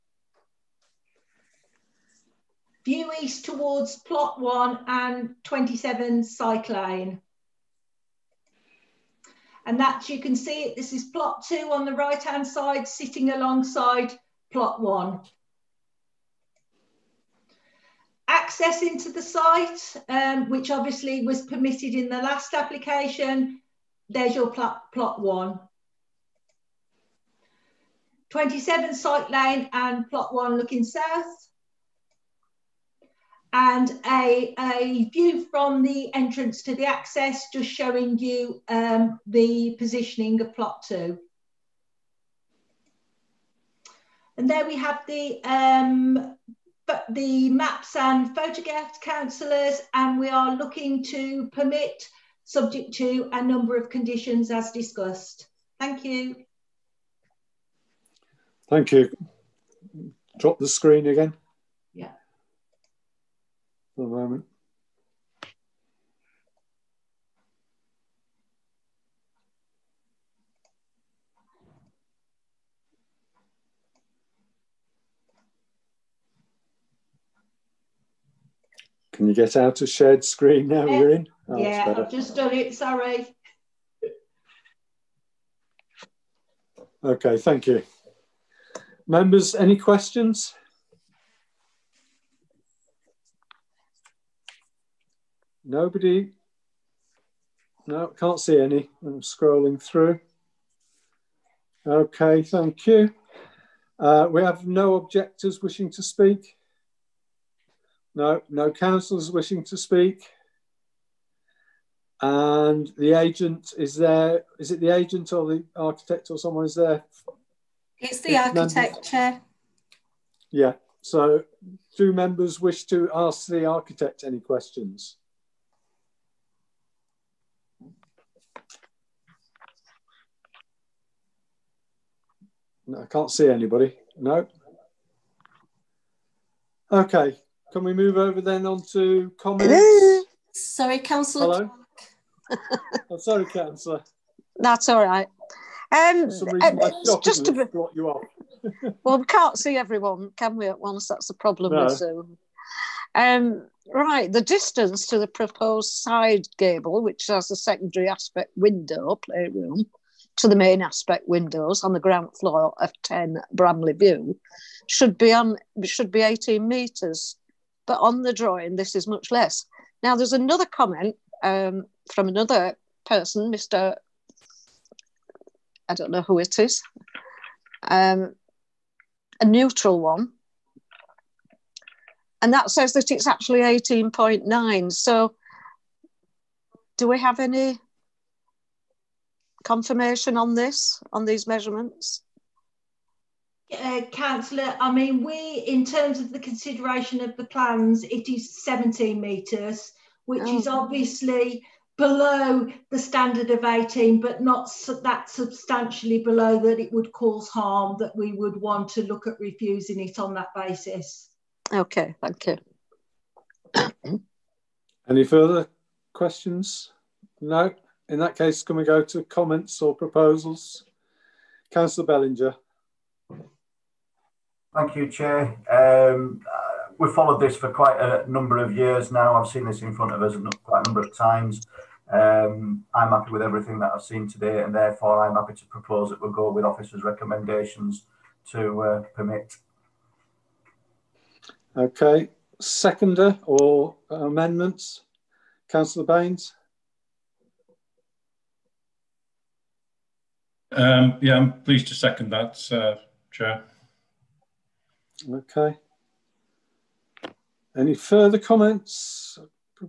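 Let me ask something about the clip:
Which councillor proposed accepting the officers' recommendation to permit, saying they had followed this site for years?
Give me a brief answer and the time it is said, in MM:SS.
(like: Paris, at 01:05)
Councillor Bellinger, at 03:41.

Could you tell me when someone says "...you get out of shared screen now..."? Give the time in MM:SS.
01:19.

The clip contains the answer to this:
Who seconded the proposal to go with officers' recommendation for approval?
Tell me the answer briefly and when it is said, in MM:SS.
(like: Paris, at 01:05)
Councillor Baines, at 04:05.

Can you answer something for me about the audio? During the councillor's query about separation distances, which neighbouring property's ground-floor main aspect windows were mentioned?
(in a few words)
10 Bramley View.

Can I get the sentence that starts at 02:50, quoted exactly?
Now, there's another comment um, from another person, Mr.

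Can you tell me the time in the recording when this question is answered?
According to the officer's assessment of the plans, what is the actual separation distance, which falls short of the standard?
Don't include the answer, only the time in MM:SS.
03:18.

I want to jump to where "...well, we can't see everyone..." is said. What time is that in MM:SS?
02:29.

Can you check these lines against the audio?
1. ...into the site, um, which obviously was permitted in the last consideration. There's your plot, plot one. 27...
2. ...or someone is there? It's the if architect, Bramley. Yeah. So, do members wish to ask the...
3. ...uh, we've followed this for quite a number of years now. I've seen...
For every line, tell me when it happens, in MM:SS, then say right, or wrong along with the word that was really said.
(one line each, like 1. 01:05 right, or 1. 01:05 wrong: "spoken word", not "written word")
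1. 00:18 wrong: "application", not "consideration"
2. 01:56 wrong: "Chair", not "Bramley"
3. 03:46 right.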